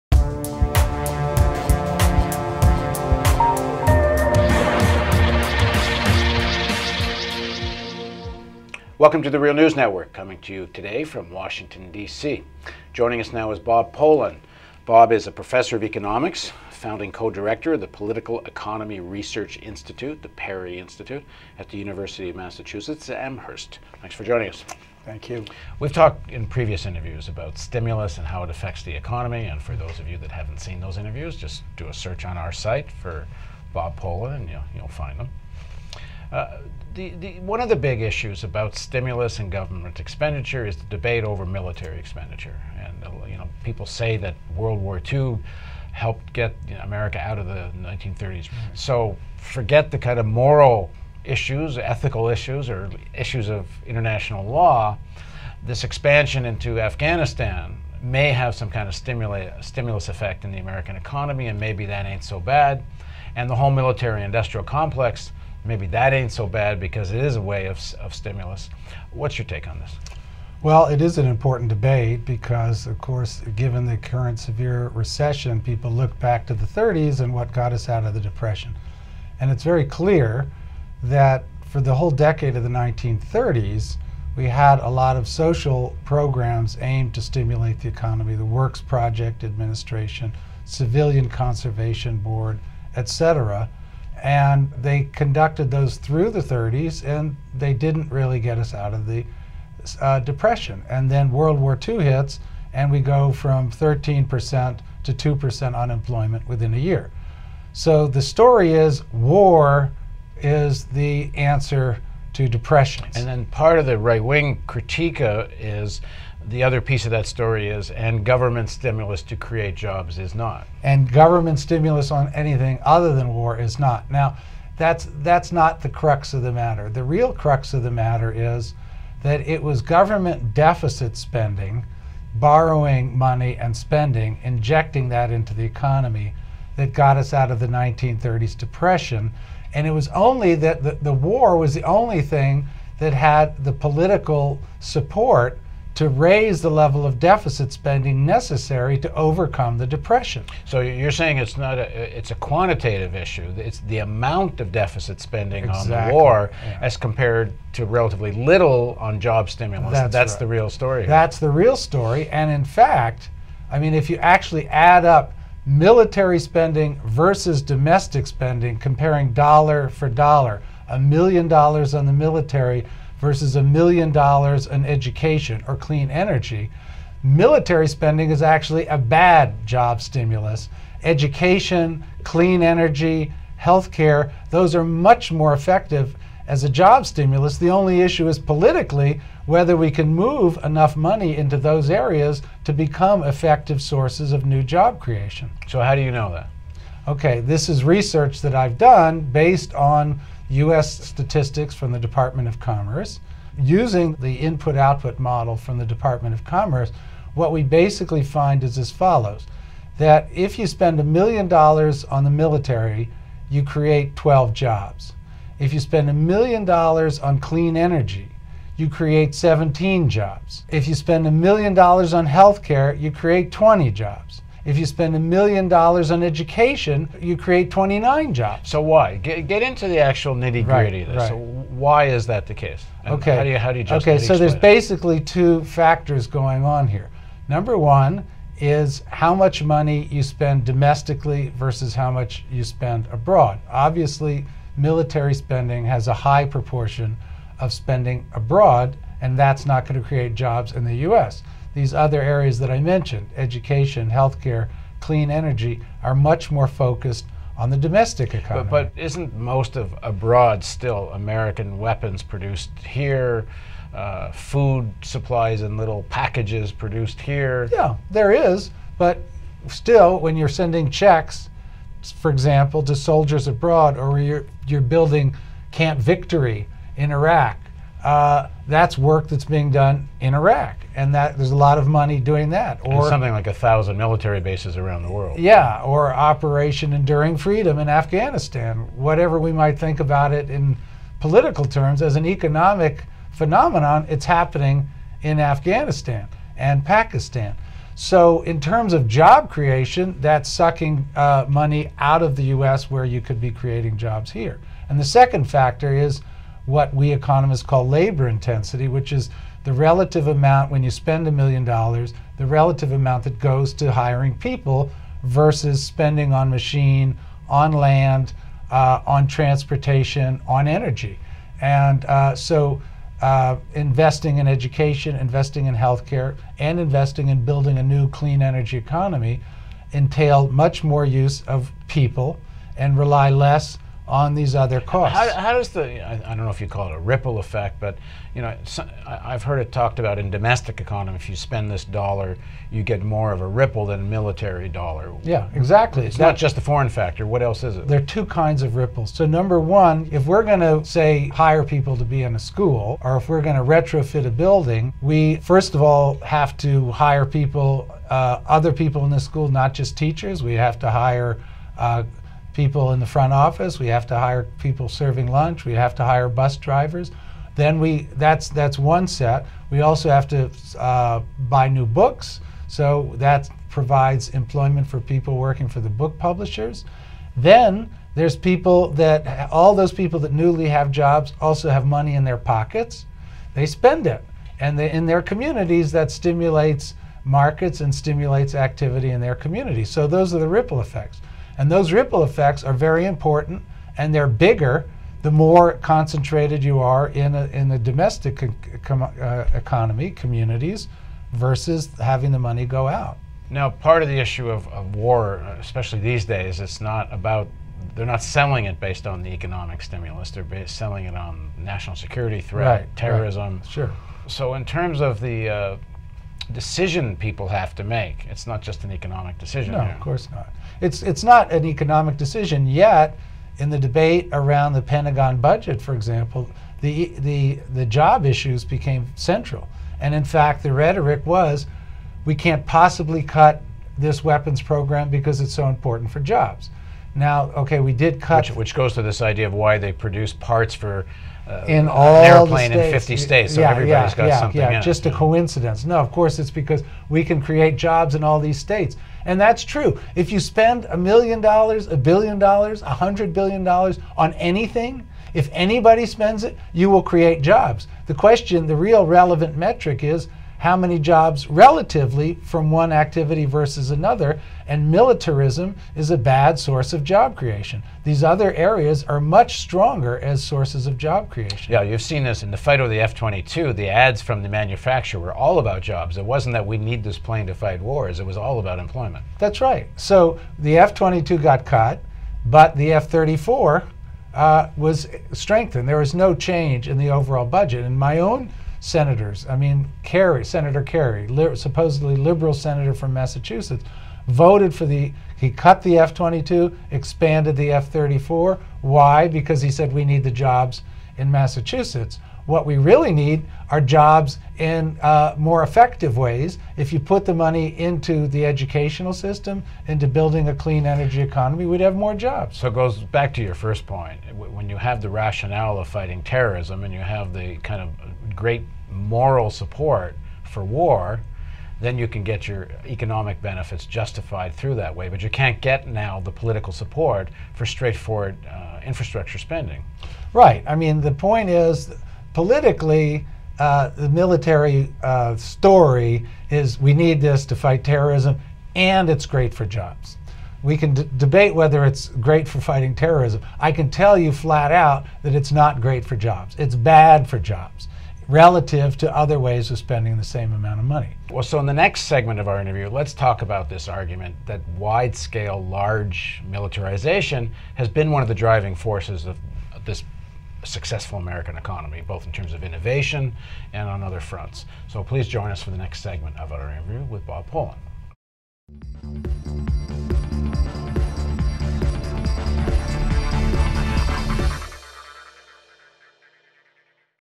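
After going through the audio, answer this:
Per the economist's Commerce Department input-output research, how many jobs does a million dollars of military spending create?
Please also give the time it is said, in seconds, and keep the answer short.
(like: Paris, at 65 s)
12, at 214 s.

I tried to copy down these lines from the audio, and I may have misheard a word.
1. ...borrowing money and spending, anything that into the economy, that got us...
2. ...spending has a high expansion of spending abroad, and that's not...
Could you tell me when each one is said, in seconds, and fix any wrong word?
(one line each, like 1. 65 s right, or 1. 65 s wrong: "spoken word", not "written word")
1. 132 s wrong: "injecting", not "anything"
2. 245 s wrong: "proportion", not "expansion".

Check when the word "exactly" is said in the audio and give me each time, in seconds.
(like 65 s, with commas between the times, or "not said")
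155 s, 345 s.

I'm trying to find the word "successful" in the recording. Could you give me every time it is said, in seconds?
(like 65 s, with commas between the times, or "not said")
560 s.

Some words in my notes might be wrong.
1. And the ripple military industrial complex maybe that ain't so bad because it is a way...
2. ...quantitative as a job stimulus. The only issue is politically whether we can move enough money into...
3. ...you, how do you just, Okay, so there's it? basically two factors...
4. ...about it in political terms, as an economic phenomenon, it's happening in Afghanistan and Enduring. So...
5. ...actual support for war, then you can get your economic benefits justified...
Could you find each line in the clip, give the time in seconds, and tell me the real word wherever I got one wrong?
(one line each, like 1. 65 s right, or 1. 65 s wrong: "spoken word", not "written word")
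1. 63 s wrong: "whole", not "ripple"
2. 185 s wrong: "effective", not "quantitative"
3. 233 s right
4. 289 s wrong: "Pakistan", not "Enduring"
5. 518 s wrong: "moral", not "actual".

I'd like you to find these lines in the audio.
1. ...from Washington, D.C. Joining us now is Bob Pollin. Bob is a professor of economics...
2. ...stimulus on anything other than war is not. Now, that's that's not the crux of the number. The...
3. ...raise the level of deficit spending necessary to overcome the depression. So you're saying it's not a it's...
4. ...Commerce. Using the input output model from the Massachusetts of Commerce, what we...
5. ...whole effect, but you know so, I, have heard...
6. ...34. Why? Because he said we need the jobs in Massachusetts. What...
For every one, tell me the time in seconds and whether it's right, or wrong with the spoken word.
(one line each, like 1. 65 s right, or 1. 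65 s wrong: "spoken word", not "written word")
1. 11 s right
2. 121 s wrong: "matter", not "number"
3. 146 s right
4. 202 s wrong: "Department", not "Massachusetts"
5. 336 s wrong: "ripple", not "whole"
6. 497 s right.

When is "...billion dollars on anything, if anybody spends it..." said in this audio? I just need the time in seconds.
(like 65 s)
453 s.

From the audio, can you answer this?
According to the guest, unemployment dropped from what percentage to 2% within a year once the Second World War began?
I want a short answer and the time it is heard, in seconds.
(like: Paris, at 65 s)
13%, at 103 s.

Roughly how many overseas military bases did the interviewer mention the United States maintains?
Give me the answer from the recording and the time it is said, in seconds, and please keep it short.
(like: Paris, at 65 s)
1,000, at 283 s.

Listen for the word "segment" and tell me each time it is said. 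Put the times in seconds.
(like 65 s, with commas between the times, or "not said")
552 s, 566 s.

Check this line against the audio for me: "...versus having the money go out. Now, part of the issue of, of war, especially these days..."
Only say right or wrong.
right.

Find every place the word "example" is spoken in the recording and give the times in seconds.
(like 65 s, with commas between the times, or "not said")
272 s, 425 s.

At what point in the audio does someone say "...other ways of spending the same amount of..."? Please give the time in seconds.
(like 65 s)
549 s.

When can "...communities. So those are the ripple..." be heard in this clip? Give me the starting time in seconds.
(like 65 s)
389 s.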